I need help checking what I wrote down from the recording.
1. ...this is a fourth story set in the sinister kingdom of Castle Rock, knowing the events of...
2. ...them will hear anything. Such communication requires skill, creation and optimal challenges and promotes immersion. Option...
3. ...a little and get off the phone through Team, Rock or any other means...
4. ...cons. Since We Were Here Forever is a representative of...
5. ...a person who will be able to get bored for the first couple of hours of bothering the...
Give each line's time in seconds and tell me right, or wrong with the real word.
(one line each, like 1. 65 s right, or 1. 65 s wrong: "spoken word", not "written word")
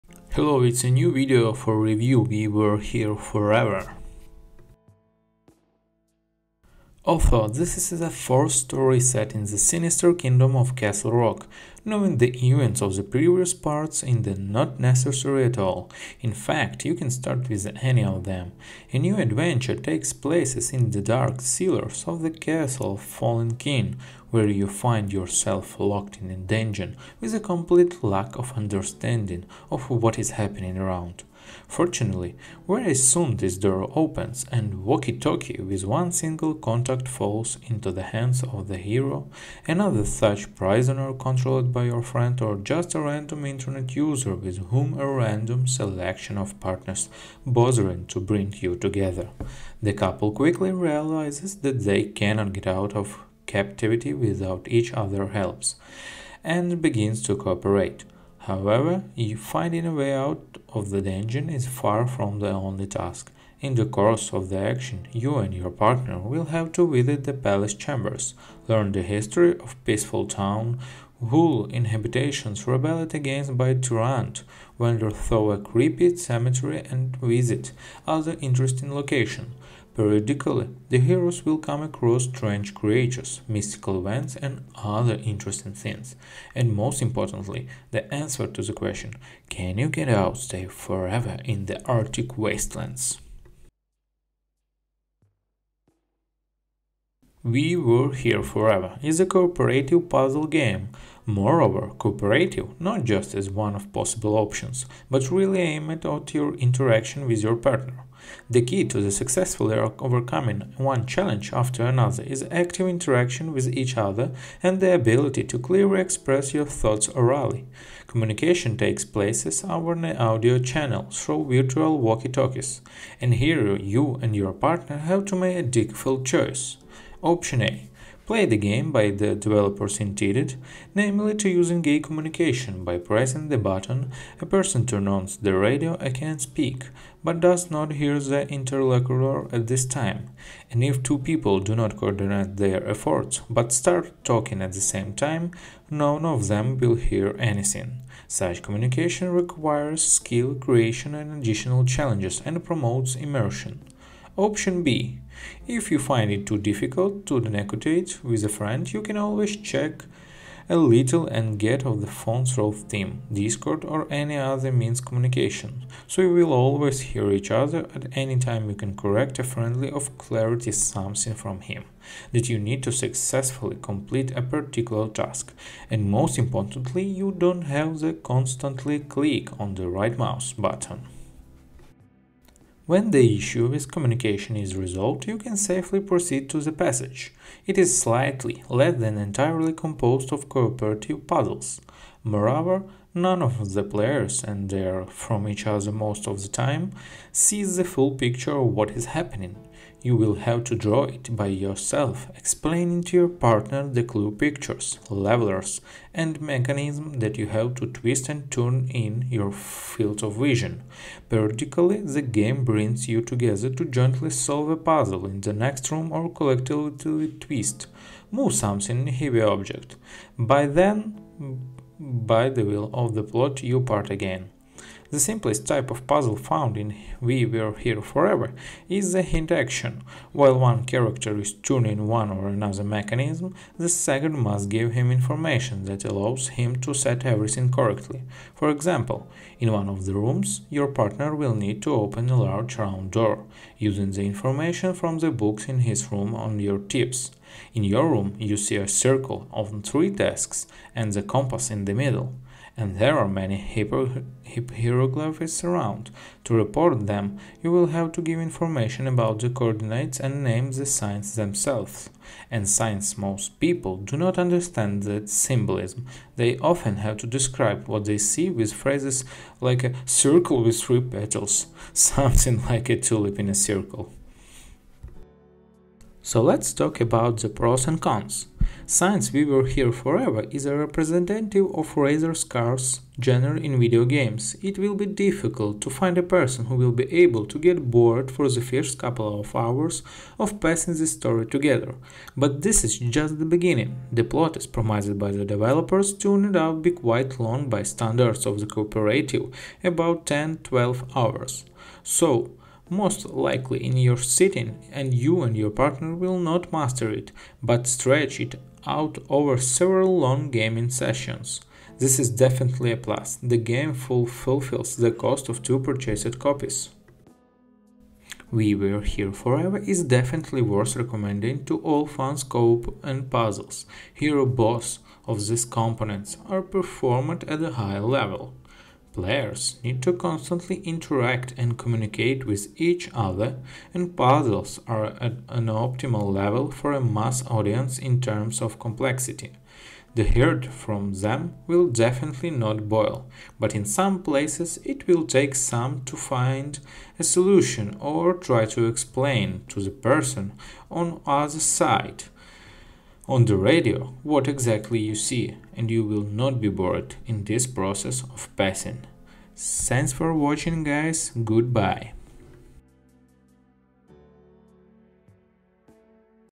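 1. 7 s right
2. 146 s wrong: "additional", not "optimal"
3. 160 s wrong: "Discord", not "Rock"
4. 278 s right
5. 286 s wrong: "passing", not "bothering".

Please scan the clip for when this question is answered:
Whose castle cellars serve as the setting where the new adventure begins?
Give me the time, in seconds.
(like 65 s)
23 s.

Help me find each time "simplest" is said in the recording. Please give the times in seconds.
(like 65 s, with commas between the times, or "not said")
225 s.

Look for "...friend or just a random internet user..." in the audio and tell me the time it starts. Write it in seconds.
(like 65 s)
42 s.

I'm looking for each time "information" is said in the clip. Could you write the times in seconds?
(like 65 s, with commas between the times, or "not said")
235 s, 244 s, 258 s.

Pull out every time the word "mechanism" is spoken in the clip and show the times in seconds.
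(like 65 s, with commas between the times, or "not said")
206 s, 232 s.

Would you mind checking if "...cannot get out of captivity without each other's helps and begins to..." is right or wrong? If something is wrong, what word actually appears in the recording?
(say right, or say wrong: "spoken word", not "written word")
right.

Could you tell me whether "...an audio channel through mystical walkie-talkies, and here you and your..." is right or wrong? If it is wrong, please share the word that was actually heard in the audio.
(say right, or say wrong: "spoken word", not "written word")
wrong: "virtual", not "mystical".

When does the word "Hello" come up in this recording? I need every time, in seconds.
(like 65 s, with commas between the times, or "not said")
0 s.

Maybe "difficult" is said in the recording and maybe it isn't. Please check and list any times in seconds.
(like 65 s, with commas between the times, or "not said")
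125 s, 156 s, 285 s.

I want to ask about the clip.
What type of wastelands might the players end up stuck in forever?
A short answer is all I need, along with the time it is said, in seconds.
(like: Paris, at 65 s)
Arctic, at 91 s.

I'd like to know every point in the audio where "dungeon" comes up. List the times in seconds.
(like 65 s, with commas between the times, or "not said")
26 s, 61 s.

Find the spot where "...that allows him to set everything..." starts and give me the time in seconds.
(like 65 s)
235 s.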